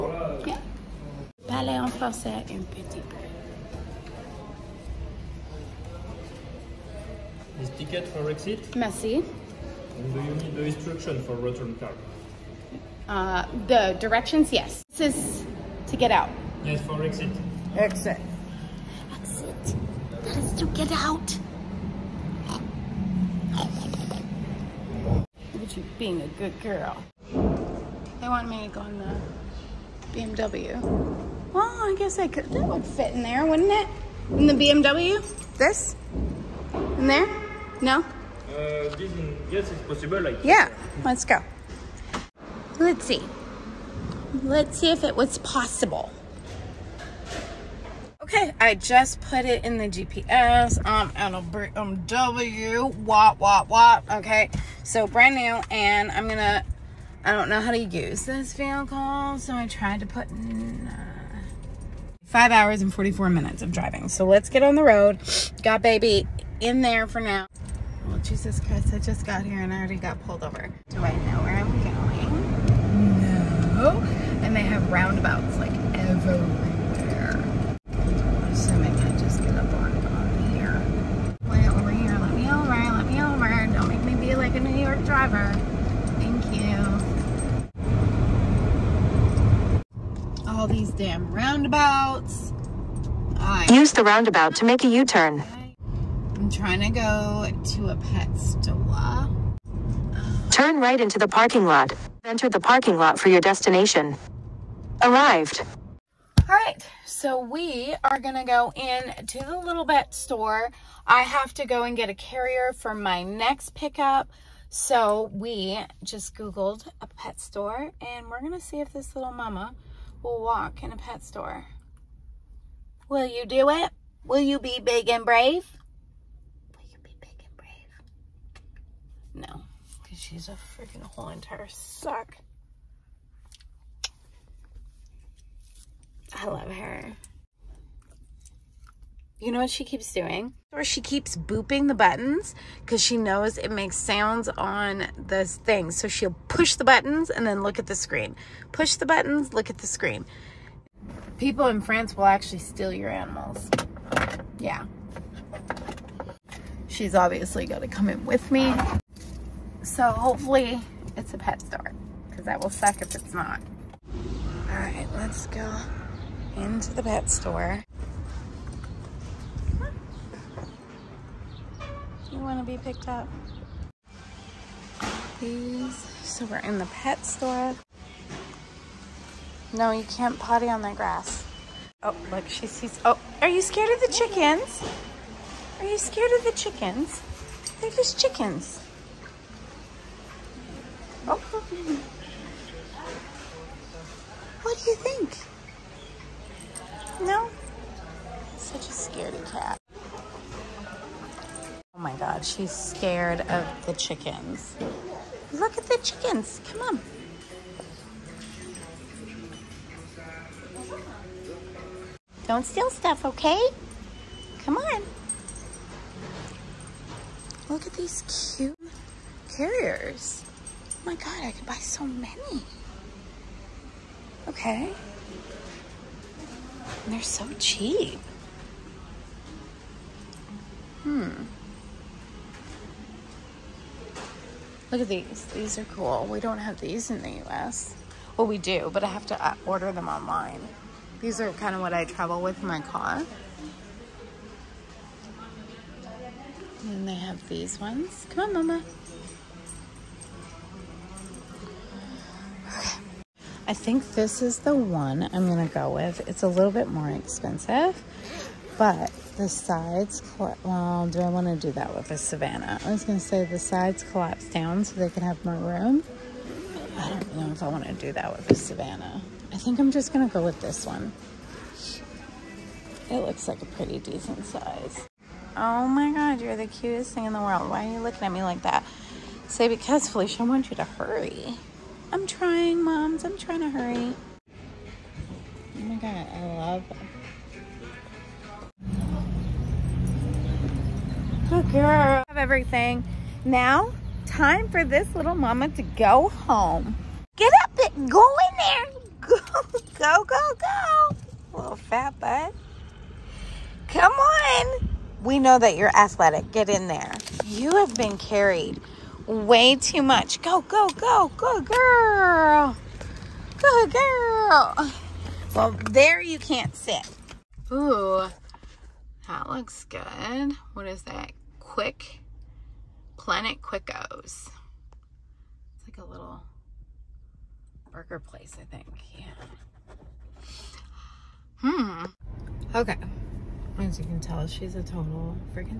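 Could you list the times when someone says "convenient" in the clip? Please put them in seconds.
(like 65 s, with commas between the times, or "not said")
not said.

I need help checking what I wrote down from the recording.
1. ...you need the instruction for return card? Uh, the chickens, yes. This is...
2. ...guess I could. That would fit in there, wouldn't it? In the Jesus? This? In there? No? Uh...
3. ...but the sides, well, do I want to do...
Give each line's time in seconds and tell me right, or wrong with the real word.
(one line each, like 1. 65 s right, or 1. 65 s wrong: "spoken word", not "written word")
1. 10 s wrong: "directions", not "chickens"
2. 31 s wrong: "BMW", not "Jesus"
3. 258 s right.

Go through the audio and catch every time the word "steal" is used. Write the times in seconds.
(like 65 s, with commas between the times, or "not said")
152 s, 212 s.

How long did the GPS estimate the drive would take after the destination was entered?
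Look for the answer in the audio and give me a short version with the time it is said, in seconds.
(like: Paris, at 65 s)
5 hours 44 minutes, at 62 s.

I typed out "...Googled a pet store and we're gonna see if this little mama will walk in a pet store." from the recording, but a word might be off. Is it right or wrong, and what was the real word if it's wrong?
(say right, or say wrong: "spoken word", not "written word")
right.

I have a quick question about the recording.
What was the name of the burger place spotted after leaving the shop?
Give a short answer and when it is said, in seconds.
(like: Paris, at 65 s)
Quick, at 321 s.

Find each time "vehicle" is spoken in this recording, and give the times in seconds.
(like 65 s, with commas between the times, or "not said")
58 s.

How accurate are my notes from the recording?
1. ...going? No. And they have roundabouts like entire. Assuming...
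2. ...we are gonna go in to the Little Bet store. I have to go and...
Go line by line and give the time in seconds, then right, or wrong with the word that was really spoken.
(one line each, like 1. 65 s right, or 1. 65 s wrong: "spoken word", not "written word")
1. 73 s wrong: "everywhere", not "entire"
2. 107 s right.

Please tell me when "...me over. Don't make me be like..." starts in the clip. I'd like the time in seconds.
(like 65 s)
83 s.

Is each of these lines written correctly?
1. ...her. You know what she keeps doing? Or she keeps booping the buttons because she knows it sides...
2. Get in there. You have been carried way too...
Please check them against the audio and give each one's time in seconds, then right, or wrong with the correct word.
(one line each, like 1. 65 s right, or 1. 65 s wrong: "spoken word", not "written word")
1. 136 s wrong: "makes", not "sides"
2. 306 s right.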